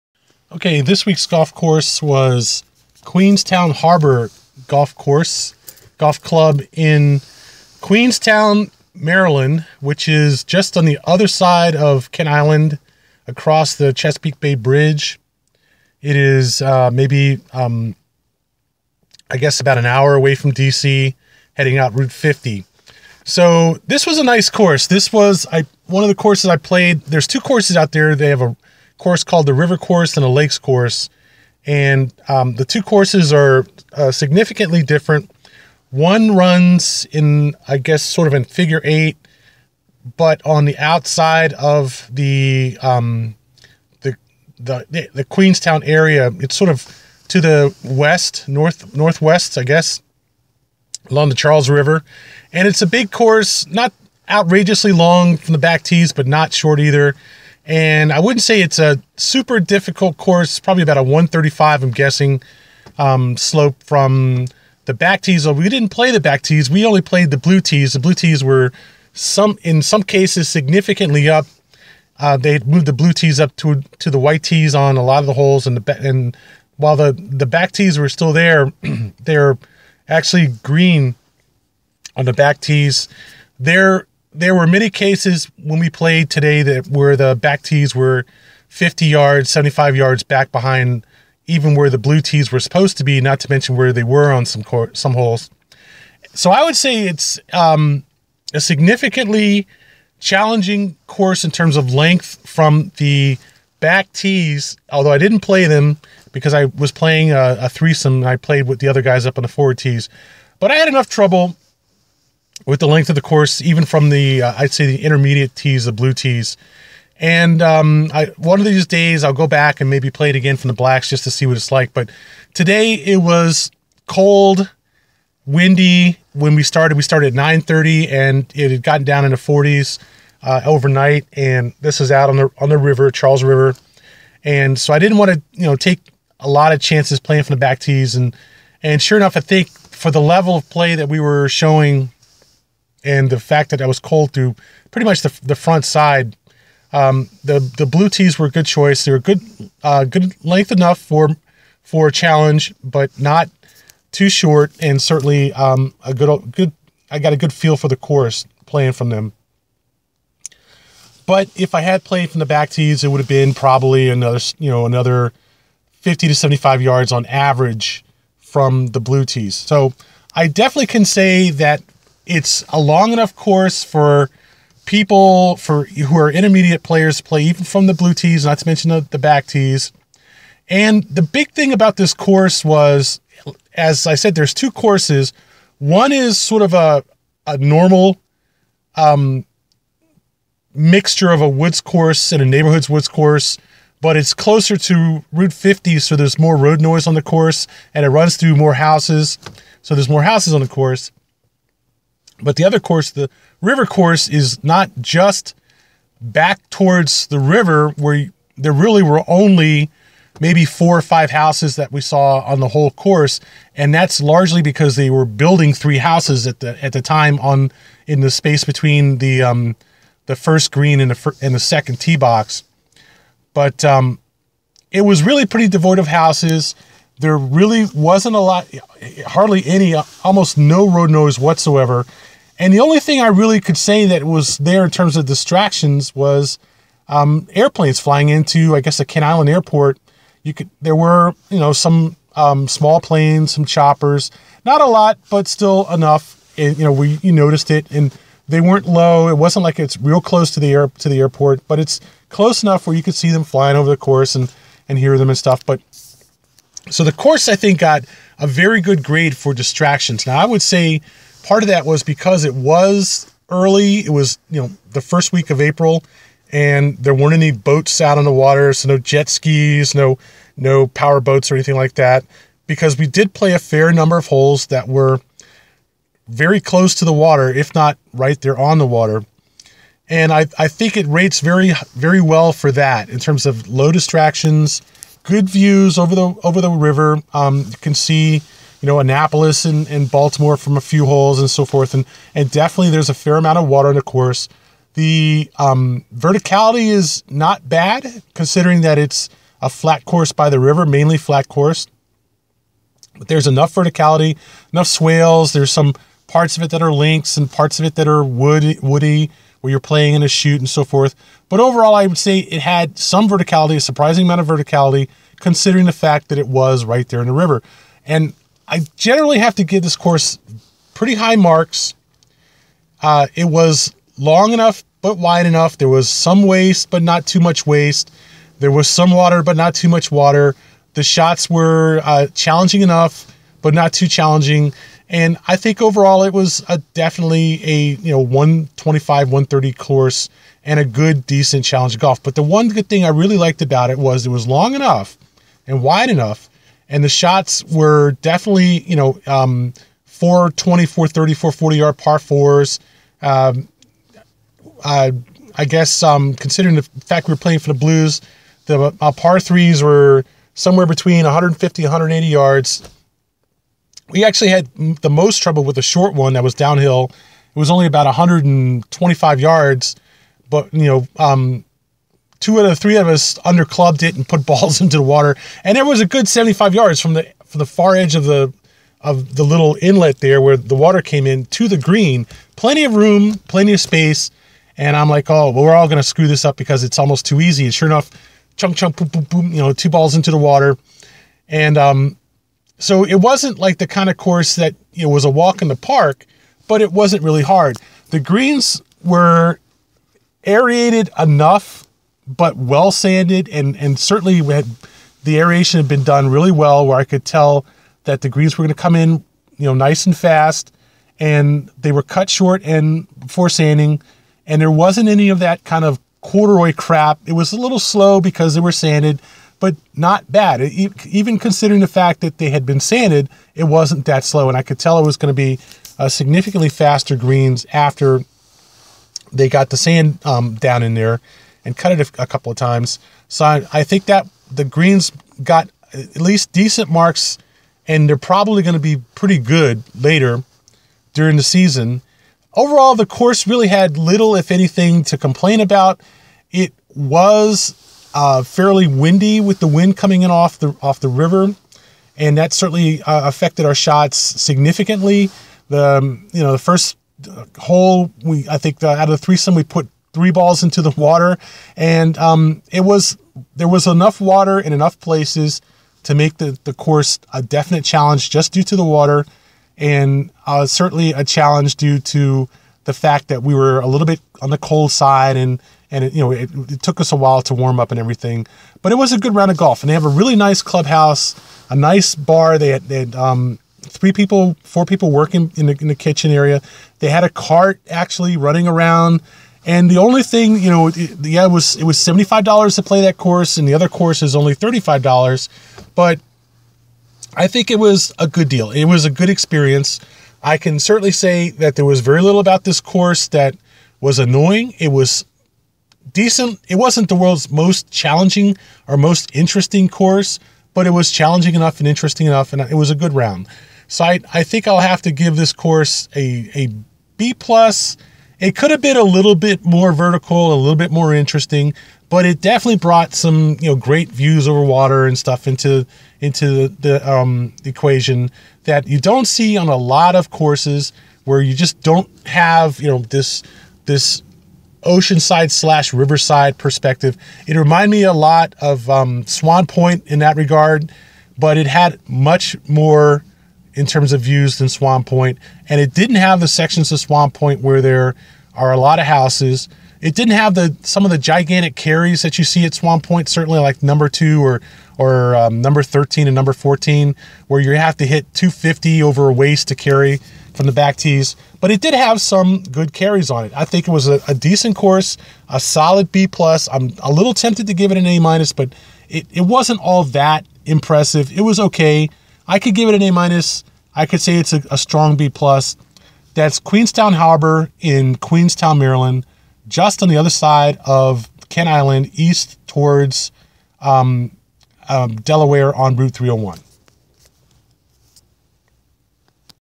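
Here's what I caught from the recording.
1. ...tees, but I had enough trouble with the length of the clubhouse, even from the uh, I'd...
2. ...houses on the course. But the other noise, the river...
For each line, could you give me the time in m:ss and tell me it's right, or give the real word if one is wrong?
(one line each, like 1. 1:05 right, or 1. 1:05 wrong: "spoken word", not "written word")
1. 1:49 wrong: "course", not "clubhouse"
2. 3:20 wrong: "course", not "noise".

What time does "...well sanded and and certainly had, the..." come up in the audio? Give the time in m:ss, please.
6:42.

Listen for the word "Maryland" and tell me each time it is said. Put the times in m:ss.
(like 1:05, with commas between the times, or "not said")
0:08, 9:38.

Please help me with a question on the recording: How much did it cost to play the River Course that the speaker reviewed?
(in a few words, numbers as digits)
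$75.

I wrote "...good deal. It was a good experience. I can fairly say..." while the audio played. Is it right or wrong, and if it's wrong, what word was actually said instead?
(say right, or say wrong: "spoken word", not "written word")
wrong: "certainly", not "fairly".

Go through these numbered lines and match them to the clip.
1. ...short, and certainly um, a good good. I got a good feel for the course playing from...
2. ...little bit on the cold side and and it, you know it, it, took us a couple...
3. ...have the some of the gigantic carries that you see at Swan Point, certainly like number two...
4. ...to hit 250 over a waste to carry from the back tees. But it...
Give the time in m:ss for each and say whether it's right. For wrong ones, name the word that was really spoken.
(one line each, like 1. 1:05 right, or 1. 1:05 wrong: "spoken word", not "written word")
1. 2:34 right
2. 7:53 wrong: "while", not "couple"
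3. 9:10 right
4. 9:17 right.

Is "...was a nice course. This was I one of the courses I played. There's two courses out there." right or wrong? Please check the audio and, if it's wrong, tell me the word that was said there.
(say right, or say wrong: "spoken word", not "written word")
right.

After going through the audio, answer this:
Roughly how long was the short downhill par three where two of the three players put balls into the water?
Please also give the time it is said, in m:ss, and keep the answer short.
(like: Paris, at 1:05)
125 yards, at 6:08.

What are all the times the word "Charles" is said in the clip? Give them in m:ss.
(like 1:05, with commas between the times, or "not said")
0:51, 2:13.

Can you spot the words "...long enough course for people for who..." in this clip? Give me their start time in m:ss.
2:52.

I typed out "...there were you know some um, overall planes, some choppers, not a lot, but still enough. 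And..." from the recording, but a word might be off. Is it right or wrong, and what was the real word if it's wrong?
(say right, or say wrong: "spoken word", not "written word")
wrong: "small", not "overall".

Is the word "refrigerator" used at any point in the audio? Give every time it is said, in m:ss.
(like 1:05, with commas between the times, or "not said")
not said.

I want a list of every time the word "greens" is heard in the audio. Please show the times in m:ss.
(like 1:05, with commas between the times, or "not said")
1:20, 3:40, 6:21, 6:38, 6:48, 7:07, 7:14.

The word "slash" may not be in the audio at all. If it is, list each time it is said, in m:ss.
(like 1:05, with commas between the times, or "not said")
8:55.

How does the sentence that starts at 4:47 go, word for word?
Um, you can see you know, Annapolis and, and Baltimore from a few holes and so forth.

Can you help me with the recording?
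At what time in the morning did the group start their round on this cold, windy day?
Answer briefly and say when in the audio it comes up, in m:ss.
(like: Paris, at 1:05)
9:30, at 2:07.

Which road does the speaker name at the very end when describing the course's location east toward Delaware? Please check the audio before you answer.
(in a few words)
Route 301.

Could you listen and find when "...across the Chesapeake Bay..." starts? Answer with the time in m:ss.
0:13.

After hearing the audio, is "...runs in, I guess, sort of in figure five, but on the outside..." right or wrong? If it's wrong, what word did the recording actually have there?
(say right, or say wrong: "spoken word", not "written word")
wrong: "eight", not "five".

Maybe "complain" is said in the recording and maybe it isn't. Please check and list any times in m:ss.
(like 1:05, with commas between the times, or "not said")
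7:25.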